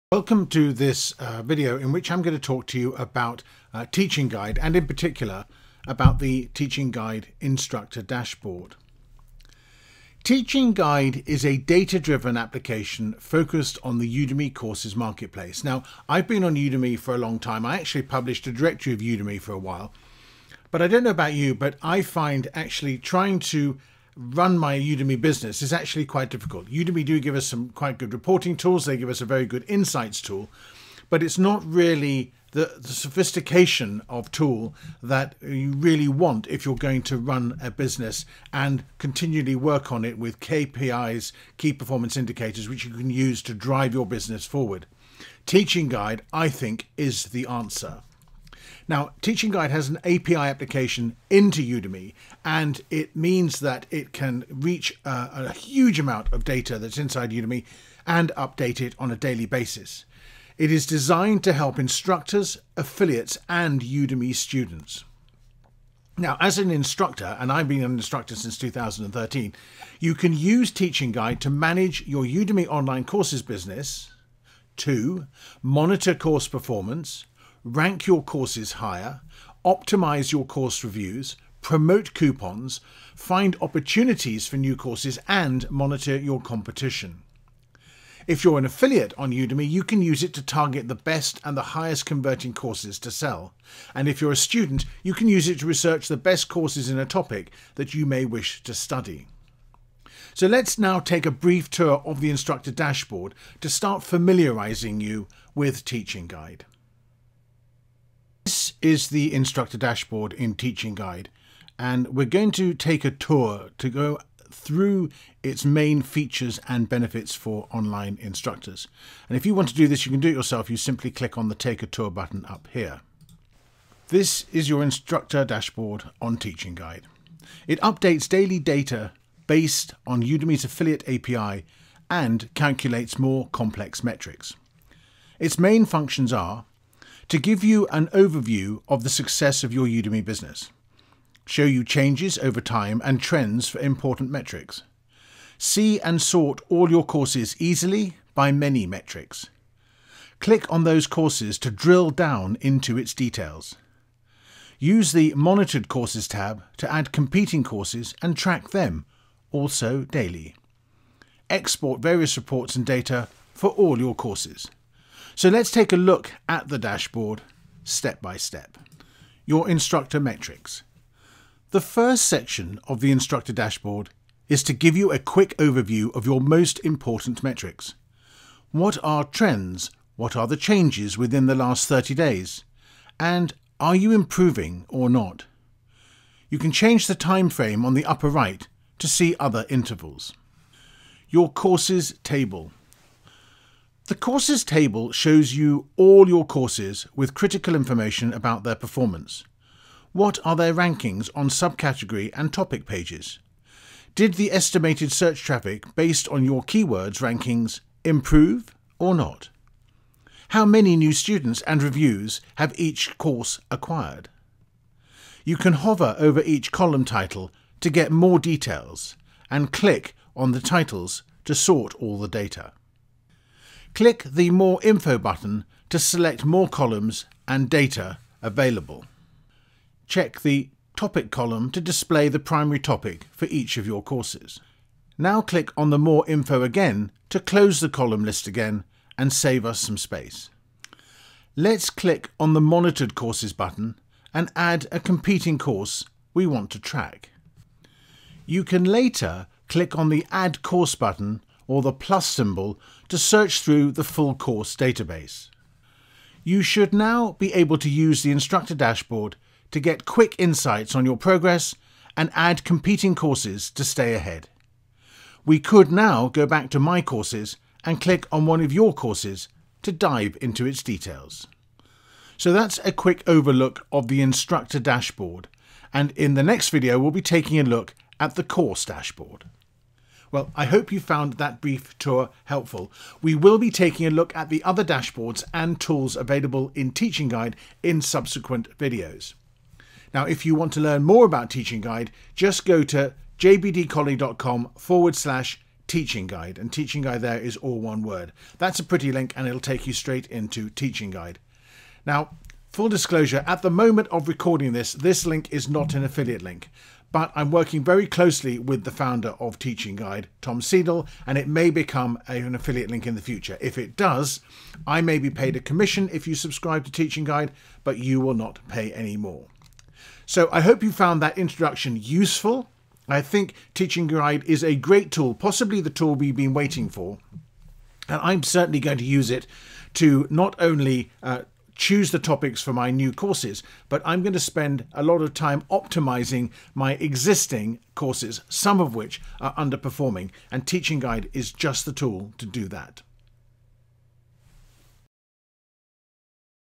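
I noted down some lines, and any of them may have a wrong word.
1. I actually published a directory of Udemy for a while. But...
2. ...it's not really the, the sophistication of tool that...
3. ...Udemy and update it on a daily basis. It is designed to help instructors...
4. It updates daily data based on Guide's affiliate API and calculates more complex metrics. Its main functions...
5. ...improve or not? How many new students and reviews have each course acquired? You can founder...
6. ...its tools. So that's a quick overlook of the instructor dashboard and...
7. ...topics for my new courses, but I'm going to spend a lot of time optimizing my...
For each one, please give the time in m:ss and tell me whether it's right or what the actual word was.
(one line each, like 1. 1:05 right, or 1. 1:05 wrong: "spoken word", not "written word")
1. 0:17 right
2. 0:31 right
3. 0:57 right
4. 2:07 wrong: "Udemy", not "Guide"
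5. 3:28 wrong: "hover", not "founder"
6. 4:30 wrong: "details", not "tools"
7. 5:32 right.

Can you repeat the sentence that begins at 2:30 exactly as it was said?
Click on those courses to drill down into its details.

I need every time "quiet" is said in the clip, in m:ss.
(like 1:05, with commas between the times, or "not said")
not said.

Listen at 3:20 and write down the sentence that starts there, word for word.
What are their rankings on subcategory and topic pages?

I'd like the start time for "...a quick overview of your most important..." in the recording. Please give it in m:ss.
2:55.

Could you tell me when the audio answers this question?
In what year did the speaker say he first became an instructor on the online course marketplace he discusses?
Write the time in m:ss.
1:08.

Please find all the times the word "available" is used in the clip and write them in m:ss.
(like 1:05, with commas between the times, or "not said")
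3:48, 4:46.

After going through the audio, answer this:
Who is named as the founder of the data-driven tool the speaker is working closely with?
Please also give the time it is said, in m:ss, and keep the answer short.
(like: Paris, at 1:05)
Tom Seidel, at 5:10.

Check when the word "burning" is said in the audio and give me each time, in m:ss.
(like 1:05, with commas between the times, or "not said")
not said.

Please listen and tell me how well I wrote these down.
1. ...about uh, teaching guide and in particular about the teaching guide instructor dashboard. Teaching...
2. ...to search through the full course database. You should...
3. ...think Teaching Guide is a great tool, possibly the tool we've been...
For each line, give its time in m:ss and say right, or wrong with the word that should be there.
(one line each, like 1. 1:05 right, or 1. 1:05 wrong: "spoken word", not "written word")
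1. 0:02 right
2. 4:13 right
3. 5:23 right.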